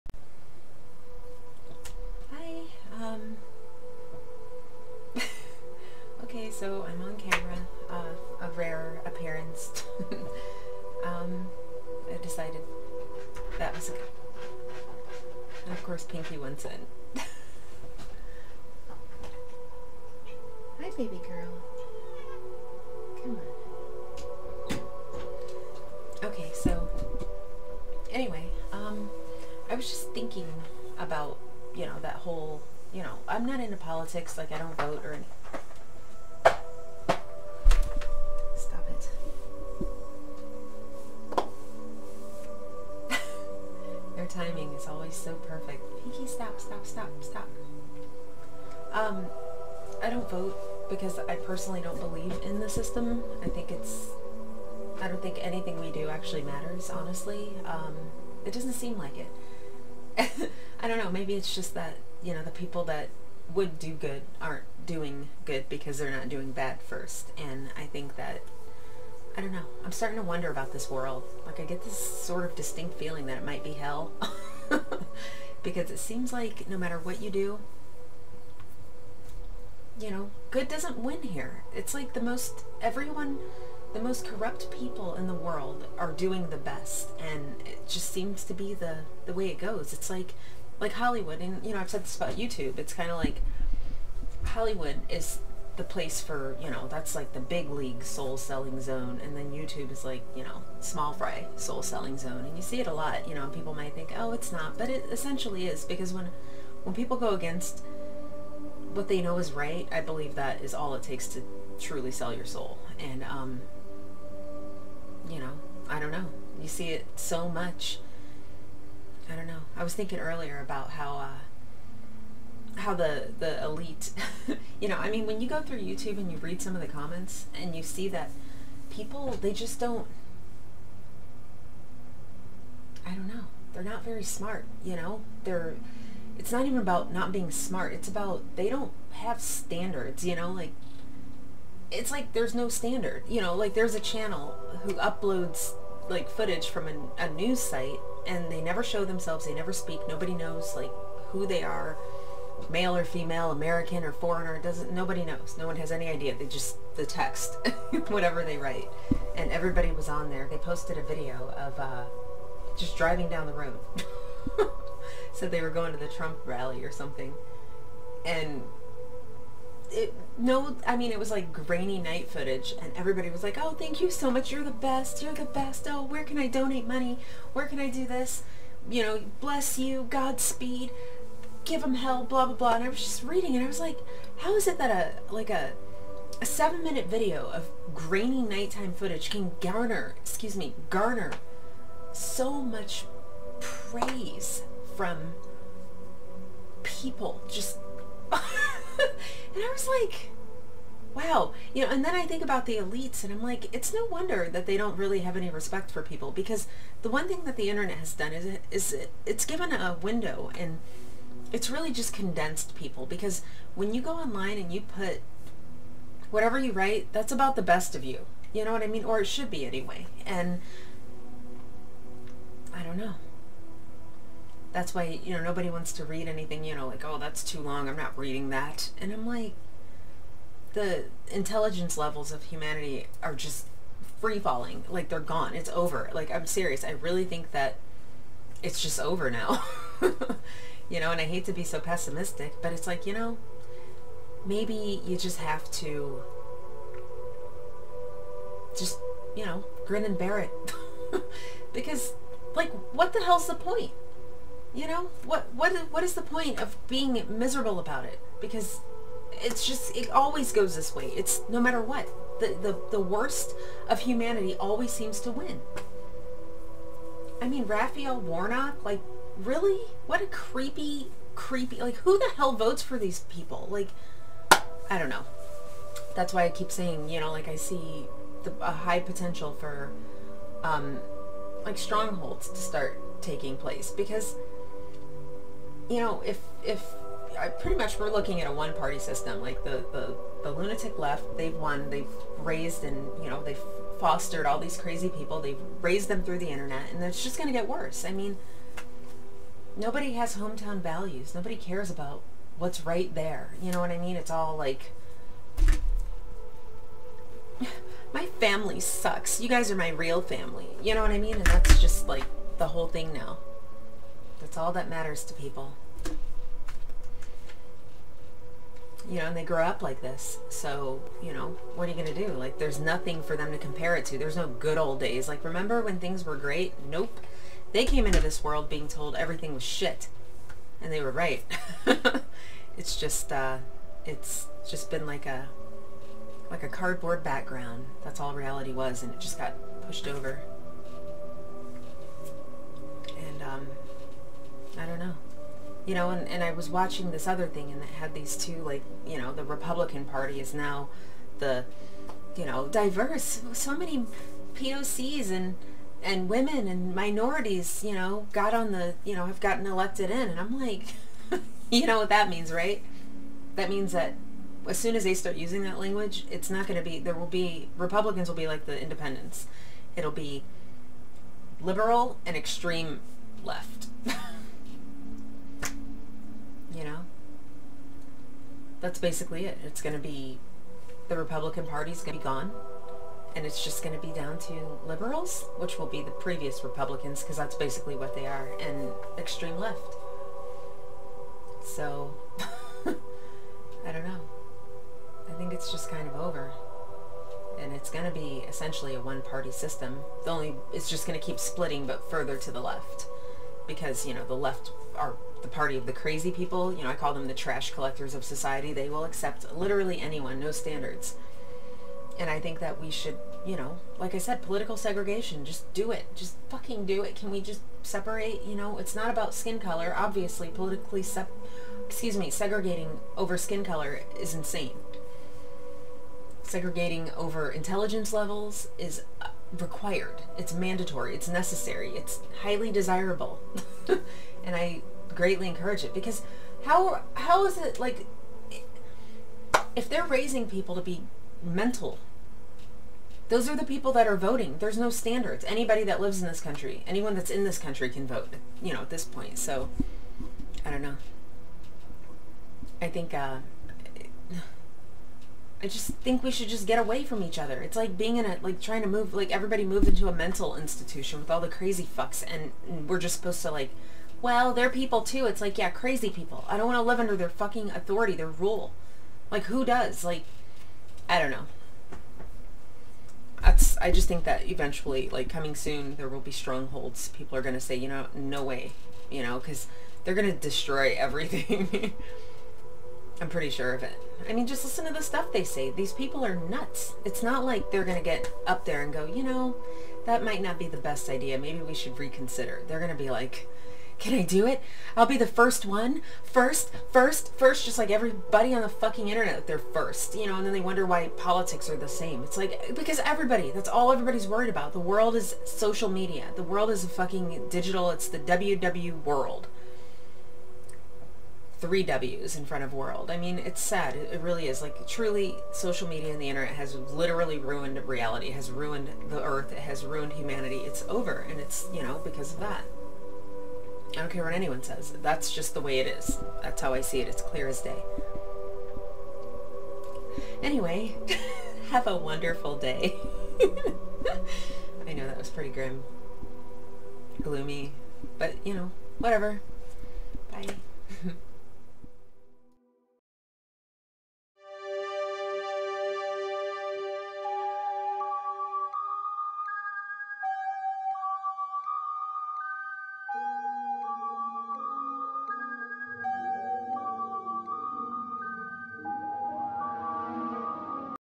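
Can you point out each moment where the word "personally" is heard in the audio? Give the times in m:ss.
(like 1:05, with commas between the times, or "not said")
0:51.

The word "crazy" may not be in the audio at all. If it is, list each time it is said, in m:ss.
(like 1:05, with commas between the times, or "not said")
4:54, 6:45, 7:41, 7:45.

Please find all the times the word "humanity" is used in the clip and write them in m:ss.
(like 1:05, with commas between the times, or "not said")
3:52, 4:23, 8:40.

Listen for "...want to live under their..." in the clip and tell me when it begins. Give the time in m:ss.
7:46.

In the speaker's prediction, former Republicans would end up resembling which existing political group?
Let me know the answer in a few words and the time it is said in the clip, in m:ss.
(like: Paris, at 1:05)
the independents, at 6:08.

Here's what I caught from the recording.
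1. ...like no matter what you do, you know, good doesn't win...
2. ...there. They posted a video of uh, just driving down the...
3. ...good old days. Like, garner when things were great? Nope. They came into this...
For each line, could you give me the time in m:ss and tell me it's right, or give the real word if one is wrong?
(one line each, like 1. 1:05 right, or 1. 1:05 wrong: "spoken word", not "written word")
1. 1:16 right
2. 2:40 right
3. 5:24 wrong: "remember", not "garner".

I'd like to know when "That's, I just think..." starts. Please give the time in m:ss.
7:53.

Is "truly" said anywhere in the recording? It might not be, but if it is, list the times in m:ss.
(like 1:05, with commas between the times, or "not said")
1:51, 8:34.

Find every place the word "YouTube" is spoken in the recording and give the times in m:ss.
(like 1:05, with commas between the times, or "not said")
1:32, 1:39, 2:05.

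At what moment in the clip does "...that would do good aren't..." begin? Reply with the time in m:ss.
1:02.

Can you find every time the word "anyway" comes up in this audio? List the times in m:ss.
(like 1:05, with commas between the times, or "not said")
3:39, 8:50.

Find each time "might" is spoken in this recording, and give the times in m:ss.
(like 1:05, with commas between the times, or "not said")
1:13, 1:43, 8:10.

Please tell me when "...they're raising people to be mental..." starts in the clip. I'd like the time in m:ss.
7:19.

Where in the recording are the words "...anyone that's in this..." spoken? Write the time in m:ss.
7:26.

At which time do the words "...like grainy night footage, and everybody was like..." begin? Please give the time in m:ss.
2:51.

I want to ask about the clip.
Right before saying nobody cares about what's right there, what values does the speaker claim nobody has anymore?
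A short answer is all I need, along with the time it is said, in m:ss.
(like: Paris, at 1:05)
hometown values, at 5:00.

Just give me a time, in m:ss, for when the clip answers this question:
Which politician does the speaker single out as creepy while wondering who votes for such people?
4:27.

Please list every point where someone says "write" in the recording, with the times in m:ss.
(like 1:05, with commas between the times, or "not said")
2:38, 3:36.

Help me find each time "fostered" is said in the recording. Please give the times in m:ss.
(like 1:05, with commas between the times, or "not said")
4:53.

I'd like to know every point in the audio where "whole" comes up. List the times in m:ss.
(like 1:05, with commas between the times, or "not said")
0:32, 5:12.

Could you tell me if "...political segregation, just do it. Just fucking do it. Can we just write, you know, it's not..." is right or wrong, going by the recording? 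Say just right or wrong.
wrong.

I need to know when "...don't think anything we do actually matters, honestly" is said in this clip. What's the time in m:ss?
0:55.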